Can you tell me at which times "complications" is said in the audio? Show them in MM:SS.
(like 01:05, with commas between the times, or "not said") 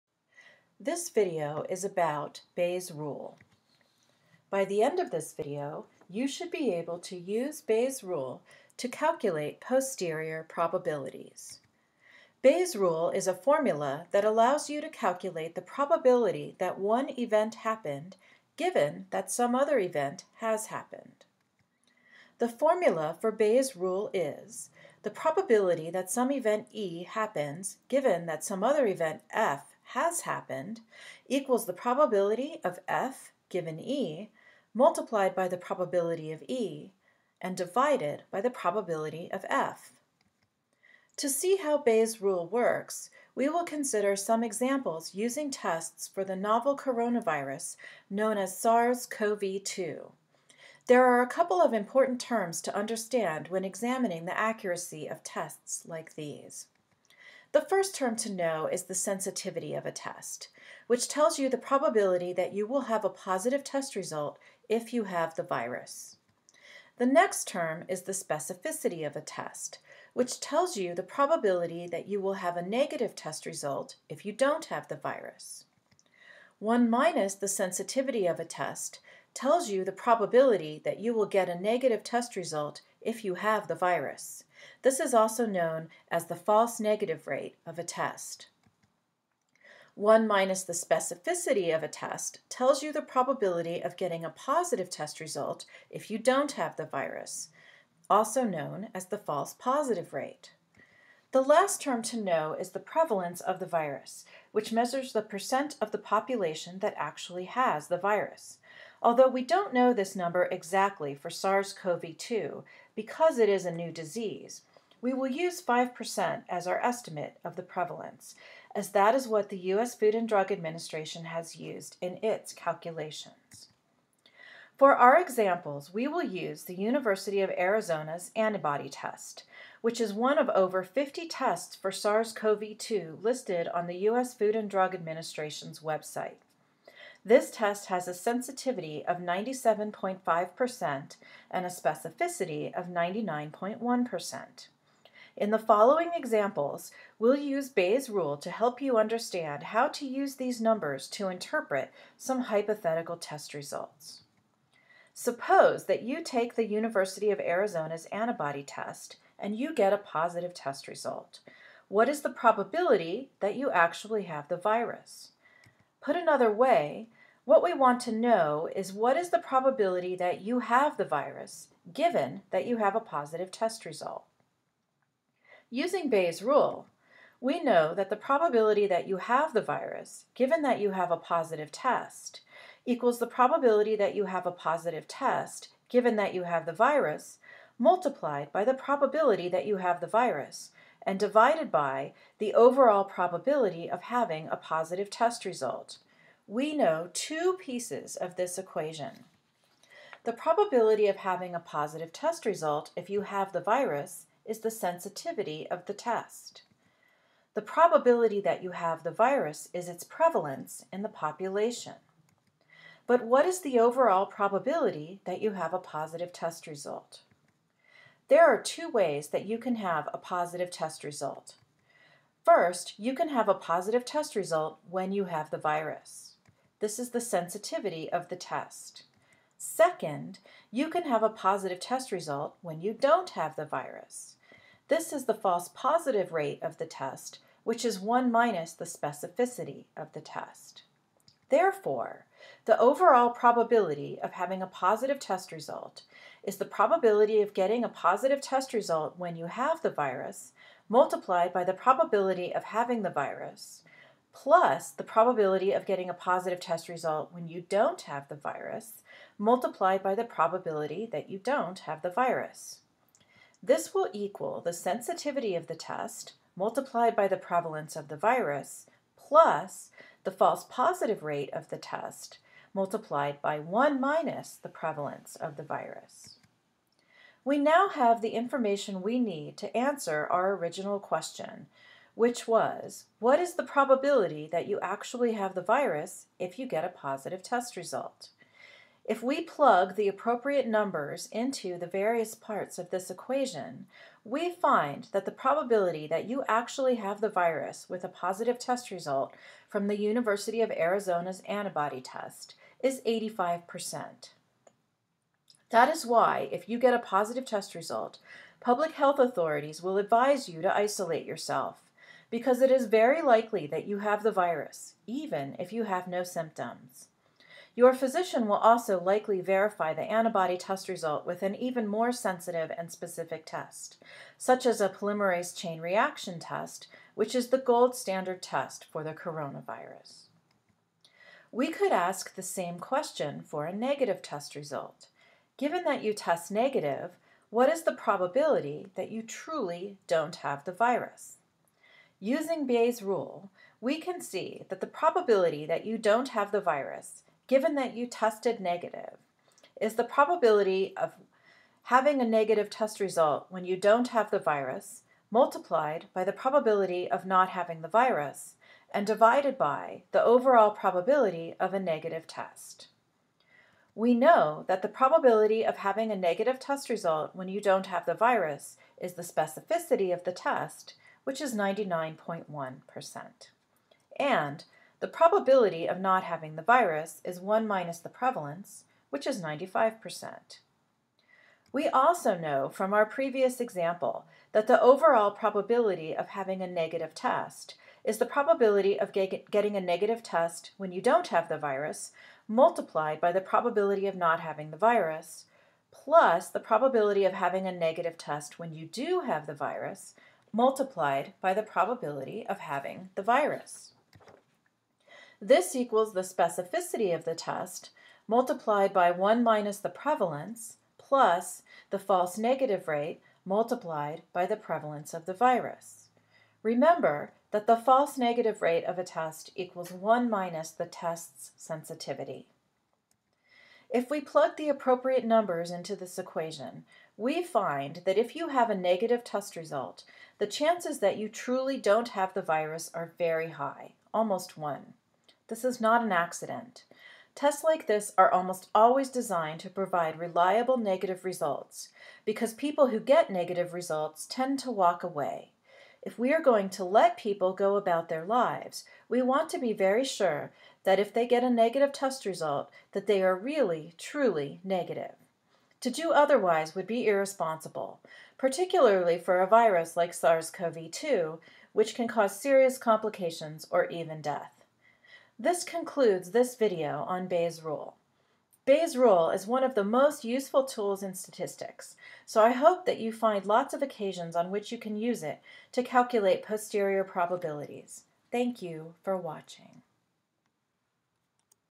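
07:42.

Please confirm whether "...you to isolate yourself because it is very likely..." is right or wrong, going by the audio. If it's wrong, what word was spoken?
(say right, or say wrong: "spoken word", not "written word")
right.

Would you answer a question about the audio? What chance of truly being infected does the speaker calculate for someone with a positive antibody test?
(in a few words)
85%.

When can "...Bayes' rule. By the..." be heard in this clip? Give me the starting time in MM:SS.
00:02.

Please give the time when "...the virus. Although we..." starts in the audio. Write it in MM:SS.
01:47.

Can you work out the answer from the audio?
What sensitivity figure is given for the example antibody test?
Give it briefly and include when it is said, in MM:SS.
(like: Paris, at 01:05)
97.5%, at 02:19.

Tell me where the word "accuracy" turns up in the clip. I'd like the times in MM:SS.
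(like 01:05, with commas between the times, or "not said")
00:54.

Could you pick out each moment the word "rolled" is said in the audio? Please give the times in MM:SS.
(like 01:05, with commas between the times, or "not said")
not said.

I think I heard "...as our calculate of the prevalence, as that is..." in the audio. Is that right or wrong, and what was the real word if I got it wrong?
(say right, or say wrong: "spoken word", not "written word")
wrong: "estimate", not "calculate".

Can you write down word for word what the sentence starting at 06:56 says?
Remember that the false negative rate of a test equals 1 minus the test's sensitivity.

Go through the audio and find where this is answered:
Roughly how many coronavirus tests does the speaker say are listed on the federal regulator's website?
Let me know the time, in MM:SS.
02:10.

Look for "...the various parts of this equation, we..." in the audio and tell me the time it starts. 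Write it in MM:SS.
04:51.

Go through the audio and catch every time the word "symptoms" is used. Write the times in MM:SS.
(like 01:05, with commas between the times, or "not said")
05:16.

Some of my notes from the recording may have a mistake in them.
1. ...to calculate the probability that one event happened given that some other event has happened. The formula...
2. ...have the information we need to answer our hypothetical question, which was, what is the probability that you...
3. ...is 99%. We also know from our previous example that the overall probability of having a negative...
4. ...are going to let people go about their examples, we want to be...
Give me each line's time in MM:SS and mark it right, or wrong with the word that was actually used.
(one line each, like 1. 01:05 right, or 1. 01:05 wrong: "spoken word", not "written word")
1. 00:14 right
2. 04:37 wrong: "original", not "hypothetical"
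3. 06:19 wrong: "95", not "99"
4. 07:26 wrong: "lives", not "examples".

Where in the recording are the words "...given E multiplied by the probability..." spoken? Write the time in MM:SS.
00:33.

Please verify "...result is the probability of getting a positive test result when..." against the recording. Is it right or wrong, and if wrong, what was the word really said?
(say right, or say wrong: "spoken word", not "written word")
right.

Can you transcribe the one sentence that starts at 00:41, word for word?
To see how Bayes' rule works, we will consider some examples using tests for the novel coronavirus known as SARS-CoV-2.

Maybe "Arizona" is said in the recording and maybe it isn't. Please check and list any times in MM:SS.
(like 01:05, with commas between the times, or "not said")
02:07, 02:37, 05:00.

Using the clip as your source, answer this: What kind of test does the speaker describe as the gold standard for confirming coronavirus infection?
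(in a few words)
polymerase chain reaction.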